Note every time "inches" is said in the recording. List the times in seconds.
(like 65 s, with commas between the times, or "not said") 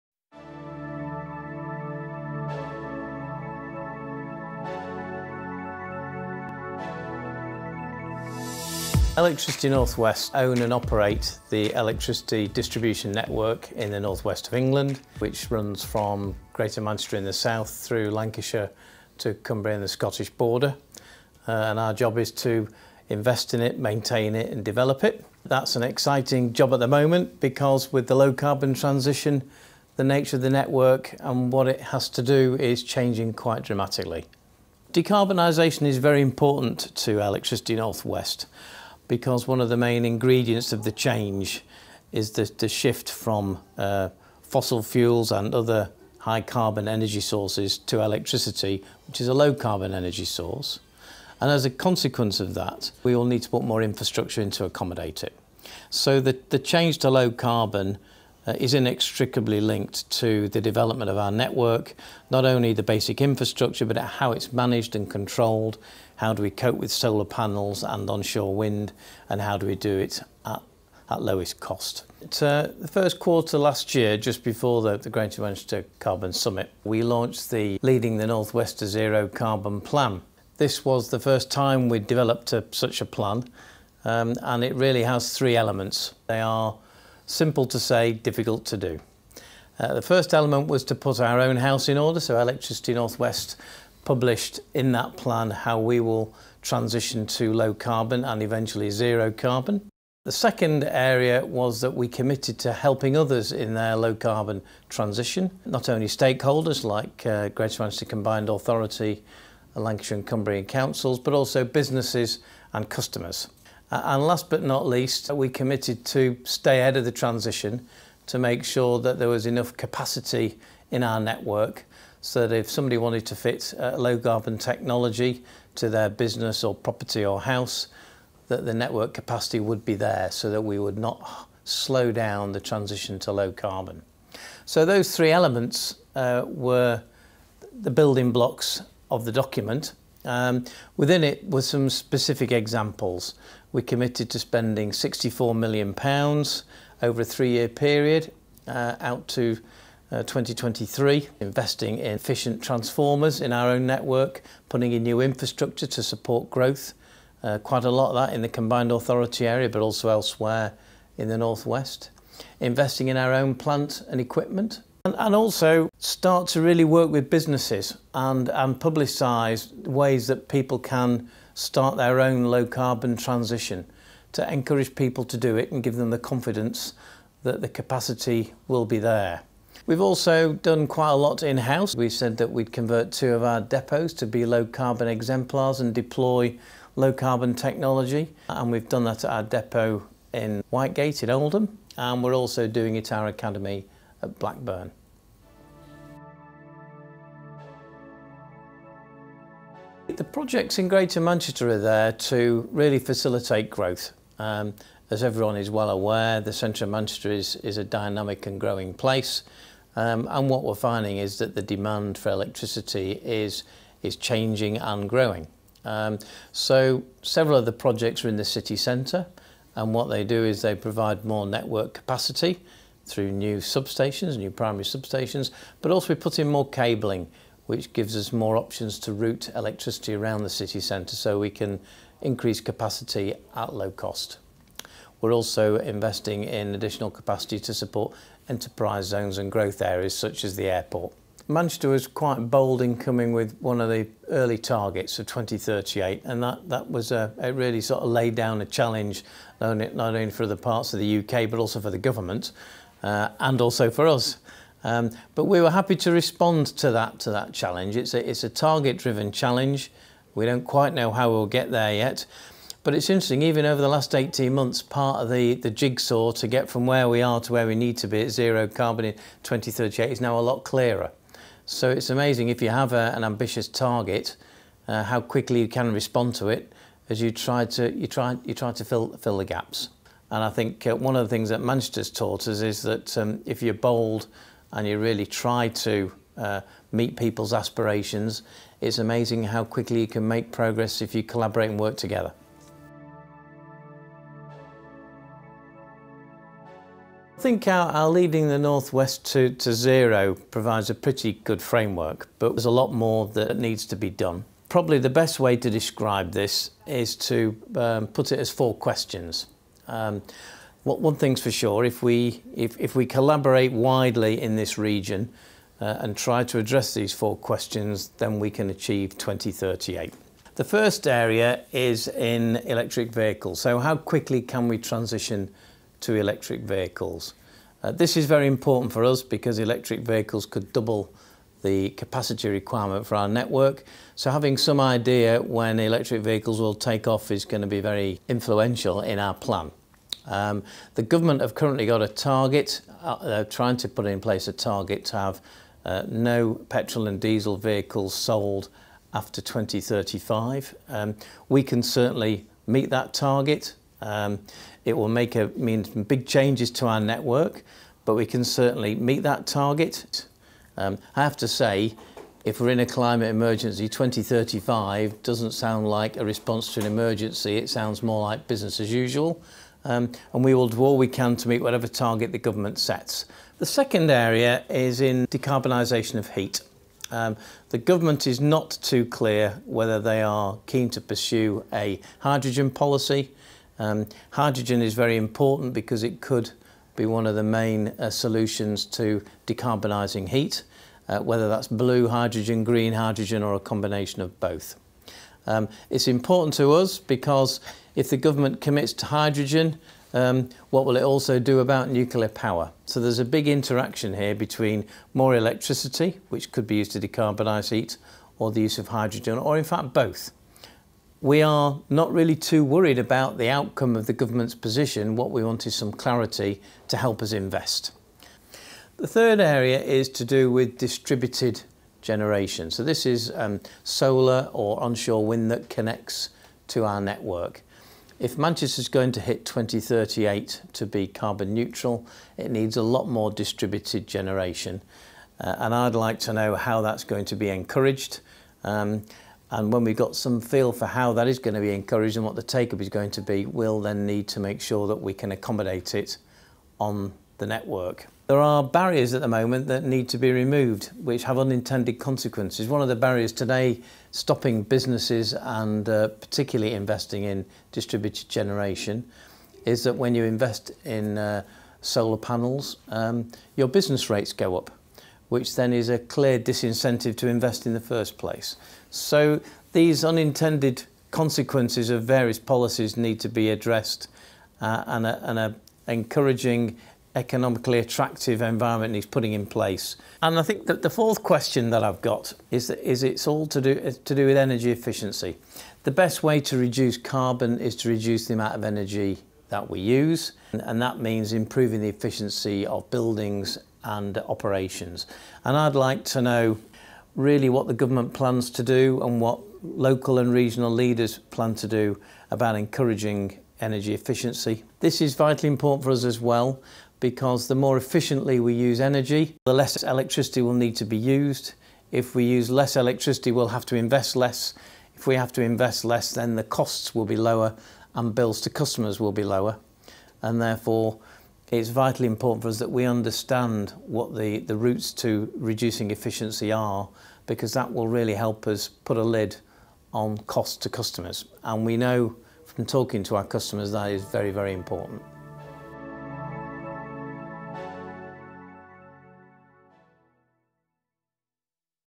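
not said.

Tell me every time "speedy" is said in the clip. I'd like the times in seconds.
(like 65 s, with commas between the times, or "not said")
not said.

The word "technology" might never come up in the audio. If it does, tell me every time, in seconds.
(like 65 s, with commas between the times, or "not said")
124 s, 187 s.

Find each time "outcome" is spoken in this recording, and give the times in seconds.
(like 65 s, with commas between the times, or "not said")
413 s.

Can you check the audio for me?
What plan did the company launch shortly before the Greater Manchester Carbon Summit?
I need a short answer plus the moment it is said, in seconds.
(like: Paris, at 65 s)
Leading the Northwest to Zero Carbon, at 77 s.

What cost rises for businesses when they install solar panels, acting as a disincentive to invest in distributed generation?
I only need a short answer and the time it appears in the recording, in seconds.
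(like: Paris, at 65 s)
business rates, at 463 s.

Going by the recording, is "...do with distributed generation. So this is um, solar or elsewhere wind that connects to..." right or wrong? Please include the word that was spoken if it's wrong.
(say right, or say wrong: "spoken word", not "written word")
wrong: "onshore", not "elsewhere".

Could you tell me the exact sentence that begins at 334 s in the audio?
So having some idea when electric vehicles will take off is going to be very influential in our plan.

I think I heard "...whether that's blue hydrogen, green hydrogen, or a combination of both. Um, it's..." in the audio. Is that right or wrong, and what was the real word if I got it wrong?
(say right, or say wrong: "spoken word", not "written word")
right.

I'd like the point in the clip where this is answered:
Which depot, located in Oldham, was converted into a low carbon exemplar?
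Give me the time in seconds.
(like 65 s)
190 s.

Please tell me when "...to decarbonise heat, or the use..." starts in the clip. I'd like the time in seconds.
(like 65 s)
406 s.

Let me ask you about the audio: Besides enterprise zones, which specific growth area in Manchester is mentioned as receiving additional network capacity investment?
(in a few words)
the airport.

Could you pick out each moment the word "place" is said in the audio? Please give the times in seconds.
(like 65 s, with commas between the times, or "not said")
208 s, 344 s, 468 s, 479 s.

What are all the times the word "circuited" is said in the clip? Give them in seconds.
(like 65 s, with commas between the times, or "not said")
not said.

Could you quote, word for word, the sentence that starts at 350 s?
Um, we can certainly meet that target.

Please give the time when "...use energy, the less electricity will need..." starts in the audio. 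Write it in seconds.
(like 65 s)
508 s.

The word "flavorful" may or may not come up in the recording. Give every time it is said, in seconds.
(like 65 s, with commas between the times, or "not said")
not said.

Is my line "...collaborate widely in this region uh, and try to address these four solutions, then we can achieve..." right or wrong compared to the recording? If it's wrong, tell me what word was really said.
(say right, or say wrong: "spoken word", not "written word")
wrong: "questions", not "solutions".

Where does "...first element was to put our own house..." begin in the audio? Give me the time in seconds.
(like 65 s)
90 s.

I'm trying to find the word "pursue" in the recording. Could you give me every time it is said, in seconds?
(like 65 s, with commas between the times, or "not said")
381 s.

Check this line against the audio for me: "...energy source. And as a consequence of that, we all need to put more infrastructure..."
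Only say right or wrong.
right.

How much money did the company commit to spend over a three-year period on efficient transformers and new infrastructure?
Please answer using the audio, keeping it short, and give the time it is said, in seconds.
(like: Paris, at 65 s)
£64 million, at 144 s.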